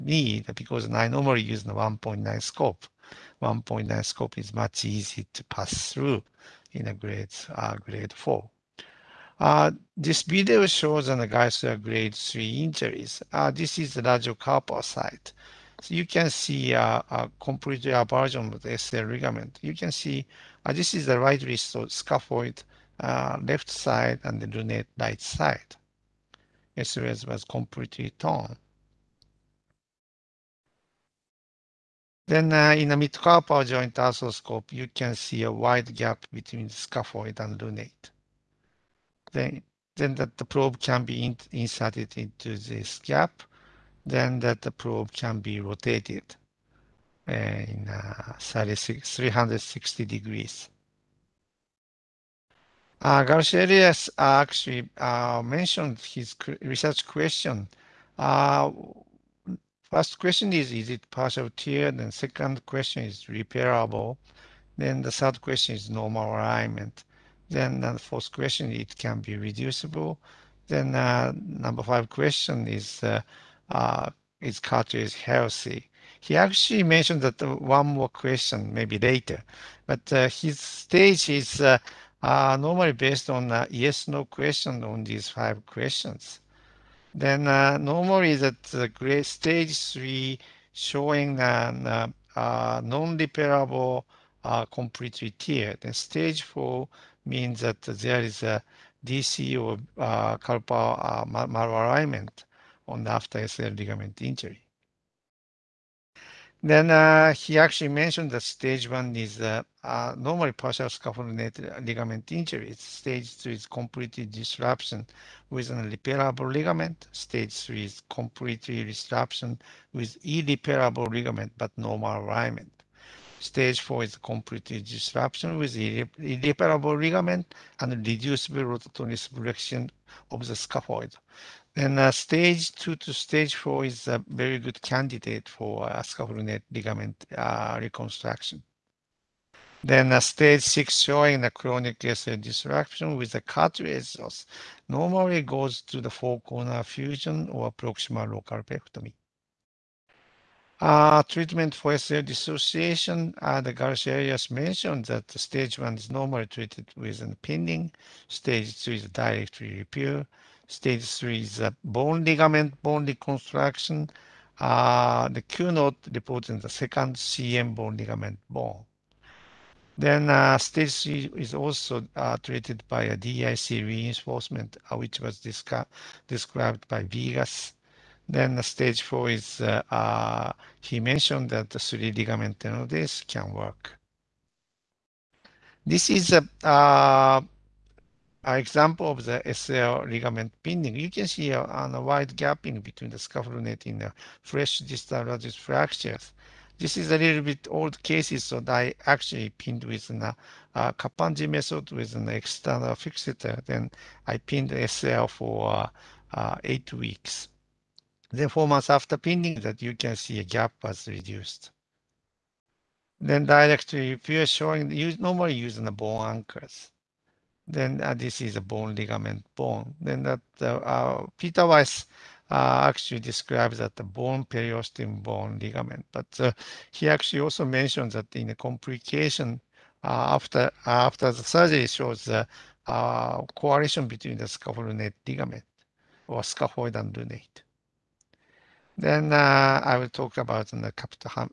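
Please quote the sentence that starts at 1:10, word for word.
Then uh, number five question is, uh, is cartridge healthy?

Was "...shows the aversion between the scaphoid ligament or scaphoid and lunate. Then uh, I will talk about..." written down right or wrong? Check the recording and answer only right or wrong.
wrong.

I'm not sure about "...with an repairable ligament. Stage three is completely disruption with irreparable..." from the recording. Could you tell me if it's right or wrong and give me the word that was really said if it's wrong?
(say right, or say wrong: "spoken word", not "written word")
right.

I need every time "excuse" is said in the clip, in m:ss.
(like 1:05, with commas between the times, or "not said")
not said.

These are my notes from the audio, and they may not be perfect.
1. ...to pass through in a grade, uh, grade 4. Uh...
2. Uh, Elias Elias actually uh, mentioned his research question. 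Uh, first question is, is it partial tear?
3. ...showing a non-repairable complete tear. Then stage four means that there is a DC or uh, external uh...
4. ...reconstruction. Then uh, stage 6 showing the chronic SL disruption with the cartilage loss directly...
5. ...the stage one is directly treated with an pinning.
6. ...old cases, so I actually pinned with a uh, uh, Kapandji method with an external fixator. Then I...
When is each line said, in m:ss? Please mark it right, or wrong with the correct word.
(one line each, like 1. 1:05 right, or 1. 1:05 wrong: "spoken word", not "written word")
1. 0:05 right
2. 0:53 wrong: "Garcia", not "Elias"
3. 1:30 wrong: "carpal", not "external"
4. 2:17 wrong: "normally", not "directly"
5. 2:35 wrong: "normally", not "directly"
6. 3:17 right.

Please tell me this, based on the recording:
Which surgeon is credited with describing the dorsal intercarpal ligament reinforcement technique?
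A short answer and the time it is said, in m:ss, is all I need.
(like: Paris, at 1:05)
Viegas, at 2:57.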